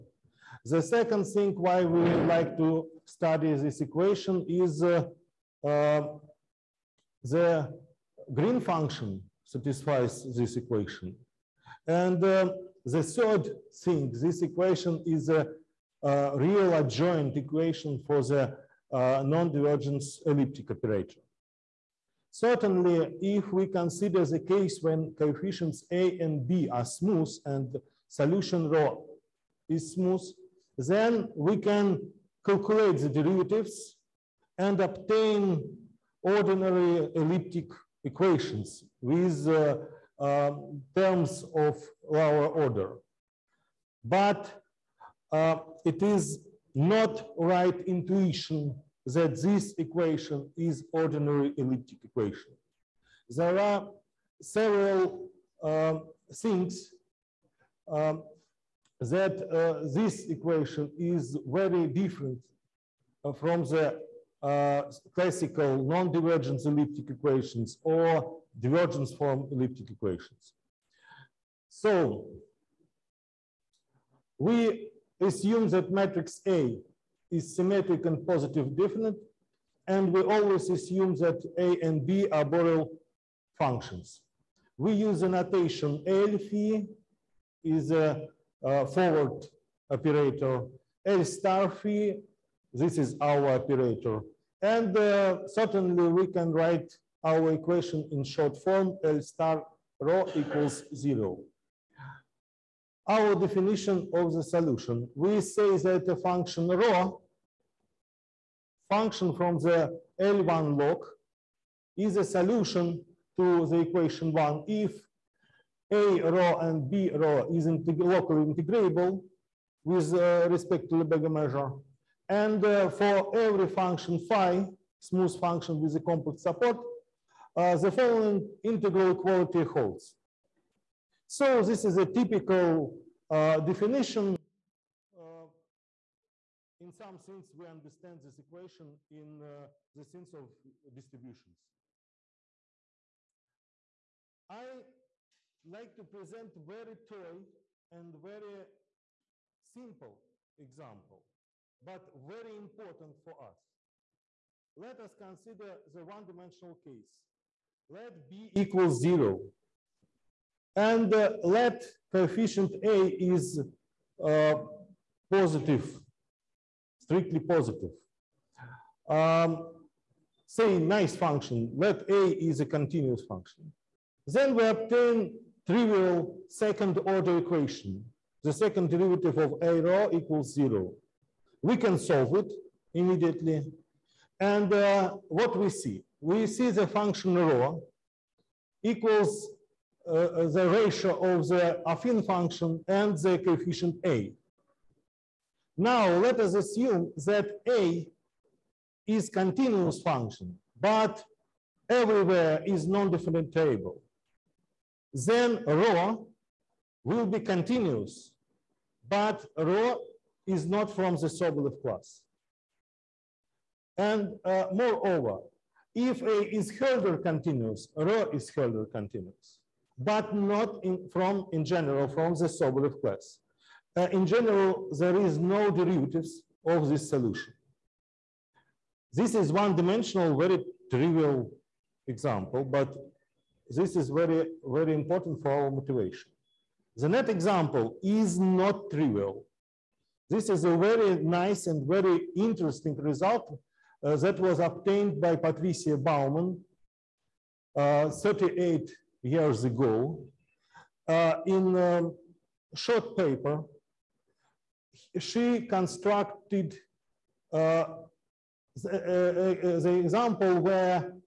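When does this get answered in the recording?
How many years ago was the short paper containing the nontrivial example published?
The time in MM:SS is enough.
04:08.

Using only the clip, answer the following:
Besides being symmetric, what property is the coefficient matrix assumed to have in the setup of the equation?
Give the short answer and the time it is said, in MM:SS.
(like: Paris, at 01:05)
positive definite, at 01:18.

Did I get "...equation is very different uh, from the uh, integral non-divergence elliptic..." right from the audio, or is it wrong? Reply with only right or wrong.
wrong.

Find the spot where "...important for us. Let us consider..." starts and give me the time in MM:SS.
02:32.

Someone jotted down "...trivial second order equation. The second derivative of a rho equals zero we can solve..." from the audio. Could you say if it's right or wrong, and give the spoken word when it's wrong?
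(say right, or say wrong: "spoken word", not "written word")
right.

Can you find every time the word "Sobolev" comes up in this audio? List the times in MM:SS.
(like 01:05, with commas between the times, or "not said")
03:31, 03:42.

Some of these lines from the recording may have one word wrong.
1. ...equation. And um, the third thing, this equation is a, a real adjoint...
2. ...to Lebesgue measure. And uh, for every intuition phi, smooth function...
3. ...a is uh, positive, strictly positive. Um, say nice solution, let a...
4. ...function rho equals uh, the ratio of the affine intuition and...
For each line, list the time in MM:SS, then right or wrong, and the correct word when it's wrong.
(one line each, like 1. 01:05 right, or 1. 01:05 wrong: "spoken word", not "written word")
1. 00:10 right
2. 02:00 wrong: "function", not "intuition"
3. 02:42 wrong: "function", not "solution"
4. 03:06 wrong: "function", not "intuition".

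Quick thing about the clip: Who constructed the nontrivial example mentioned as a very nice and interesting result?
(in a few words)
Patricia Bauman.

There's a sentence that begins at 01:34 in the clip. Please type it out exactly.
And uh, certainly we can write our equation in short form, L star rho equals zero.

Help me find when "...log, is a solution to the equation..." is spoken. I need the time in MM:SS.
01:50.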